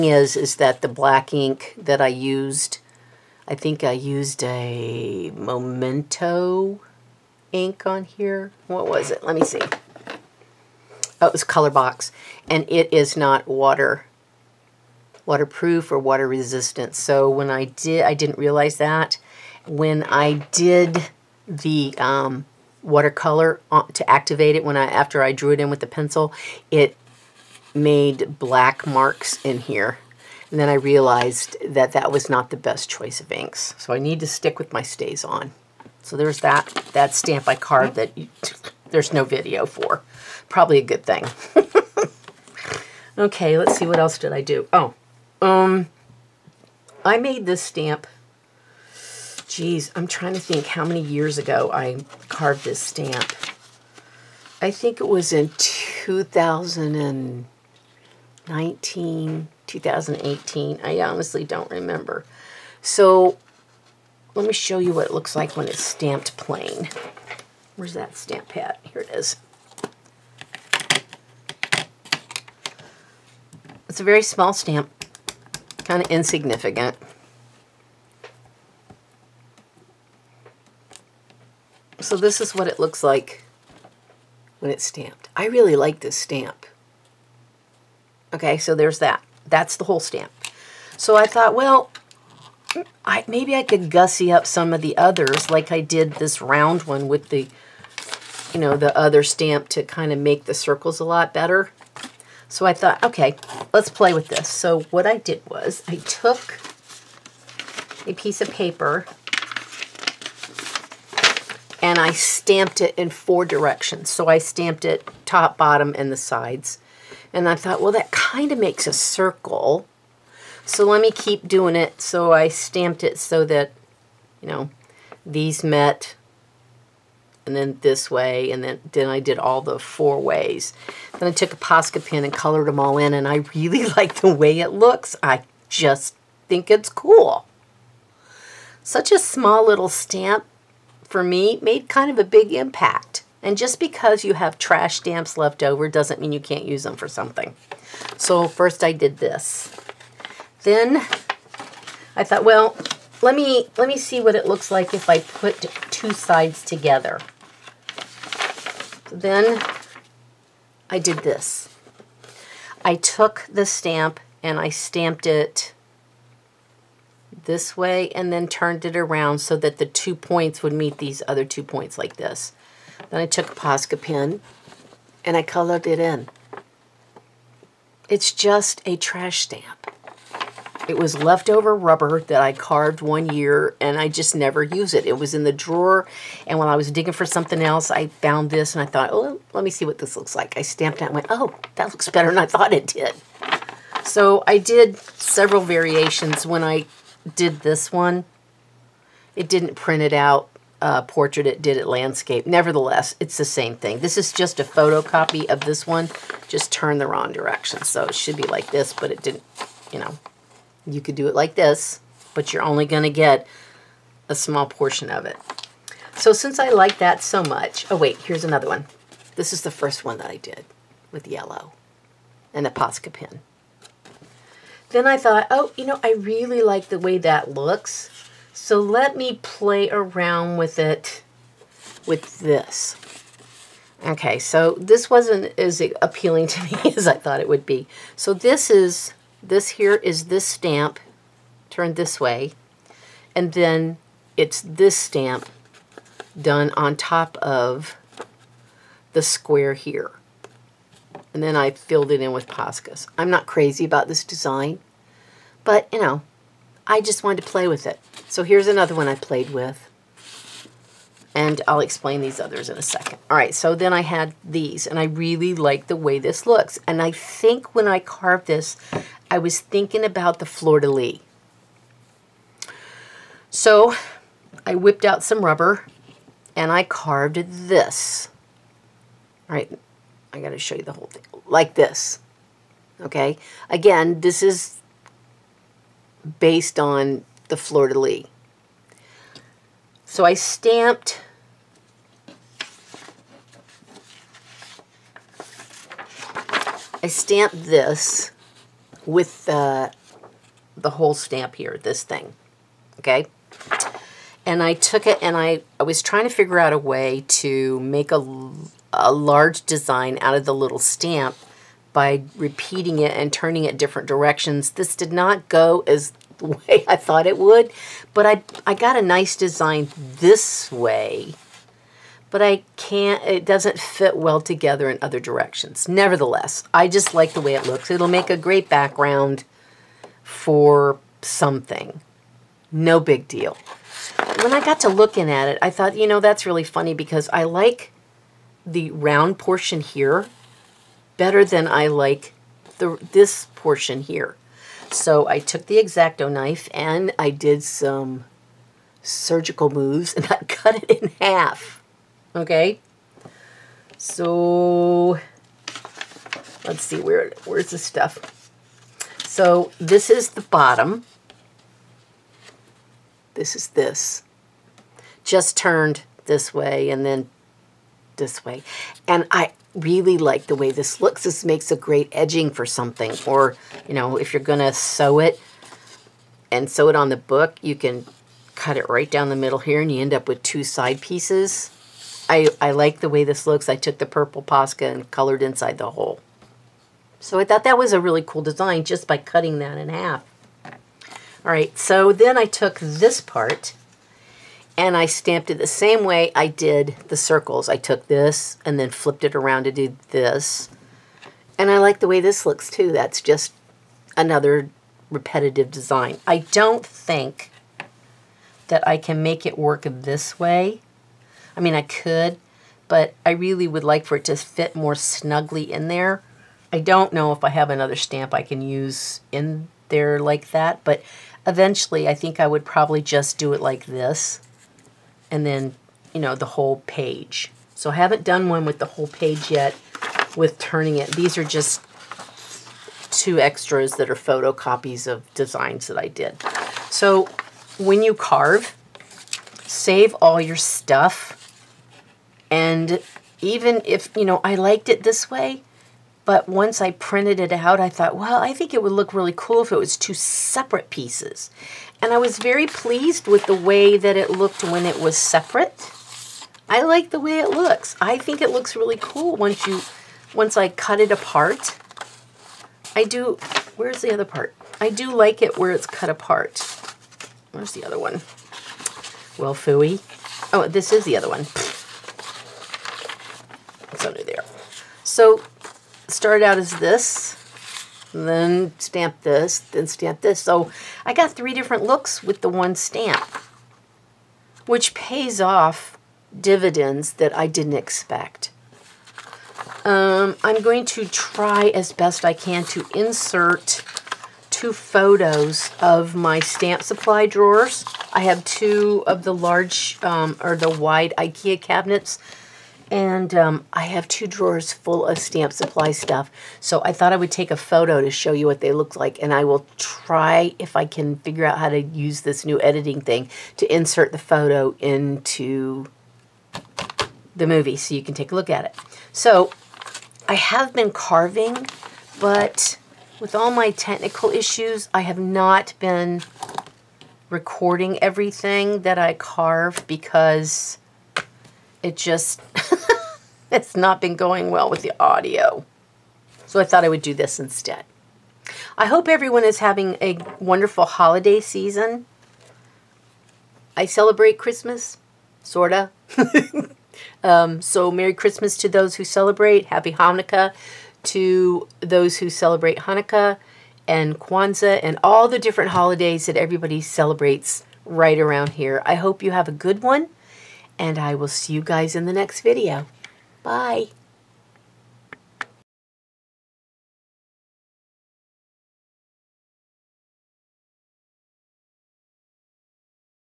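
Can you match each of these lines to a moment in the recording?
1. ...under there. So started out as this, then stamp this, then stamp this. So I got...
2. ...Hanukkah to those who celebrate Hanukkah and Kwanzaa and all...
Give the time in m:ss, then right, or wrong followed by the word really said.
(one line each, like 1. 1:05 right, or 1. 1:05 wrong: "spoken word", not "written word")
1. 7:54 right
2. 9:09 right.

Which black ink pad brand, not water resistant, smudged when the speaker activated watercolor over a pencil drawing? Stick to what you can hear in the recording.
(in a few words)
ColorBox.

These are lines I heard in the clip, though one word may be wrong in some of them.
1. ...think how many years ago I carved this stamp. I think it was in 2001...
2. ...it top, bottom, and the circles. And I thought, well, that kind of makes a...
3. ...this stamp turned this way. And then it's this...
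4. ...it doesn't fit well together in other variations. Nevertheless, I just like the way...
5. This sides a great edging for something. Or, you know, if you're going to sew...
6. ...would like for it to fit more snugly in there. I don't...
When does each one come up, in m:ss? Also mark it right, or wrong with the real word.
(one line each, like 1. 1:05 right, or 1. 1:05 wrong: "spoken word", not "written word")
1. 0:50 wrong: "2000", not "2001"
2. 1:54 wrong: "sides", not "circles"
3. 4:00 right
4. 5:23 wrong: "directions", not "variations"
5. 6:11 wrong: "makes", not "sides"
6. 6:53 right.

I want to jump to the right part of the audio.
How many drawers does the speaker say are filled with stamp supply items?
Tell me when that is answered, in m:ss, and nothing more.
8:24.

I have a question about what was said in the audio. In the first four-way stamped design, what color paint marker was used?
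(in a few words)
Yellow.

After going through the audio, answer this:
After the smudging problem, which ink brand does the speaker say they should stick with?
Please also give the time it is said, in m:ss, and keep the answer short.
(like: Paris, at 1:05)
StazOn, at 0:34.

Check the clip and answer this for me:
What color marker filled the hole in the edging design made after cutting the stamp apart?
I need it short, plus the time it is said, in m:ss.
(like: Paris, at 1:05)
Purple, at 6:24.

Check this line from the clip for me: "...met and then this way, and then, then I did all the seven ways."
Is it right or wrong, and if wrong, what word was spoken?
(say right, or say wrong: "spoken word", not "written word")
wrong: "four", not "seven".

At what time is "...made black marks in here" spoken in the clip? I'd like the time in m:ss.
0:27.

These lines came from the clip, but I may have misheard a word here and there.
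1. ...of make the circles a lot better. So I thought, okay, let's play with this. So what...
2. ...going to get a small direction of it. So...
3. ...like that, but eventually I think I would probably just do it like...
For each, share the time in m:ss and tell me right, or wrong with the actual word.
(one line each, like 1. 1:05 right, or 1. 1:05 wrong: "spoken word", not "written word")
1. 1:40 right
2. 3:32 wrong: "portion", not "direction"
3. 7:00 right.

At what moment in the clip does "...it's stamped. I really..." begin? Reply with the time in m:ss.
1:24.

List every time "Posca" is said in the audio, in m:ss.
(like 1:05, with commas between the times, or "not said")
2:11, 2:53, 3:42, 4:12, 6:24.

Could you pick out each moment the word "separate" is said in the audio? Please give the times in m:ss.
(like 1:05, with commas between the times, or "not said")
7:30, 7:35.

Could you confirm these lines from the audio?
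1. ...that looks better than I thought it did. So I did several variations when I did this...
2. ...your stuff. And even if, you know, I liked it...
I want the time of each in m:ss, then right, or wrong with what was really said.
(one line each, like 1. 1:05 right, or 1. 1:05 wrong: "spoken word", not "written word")
1. 3:11 right
2. 7:20 right.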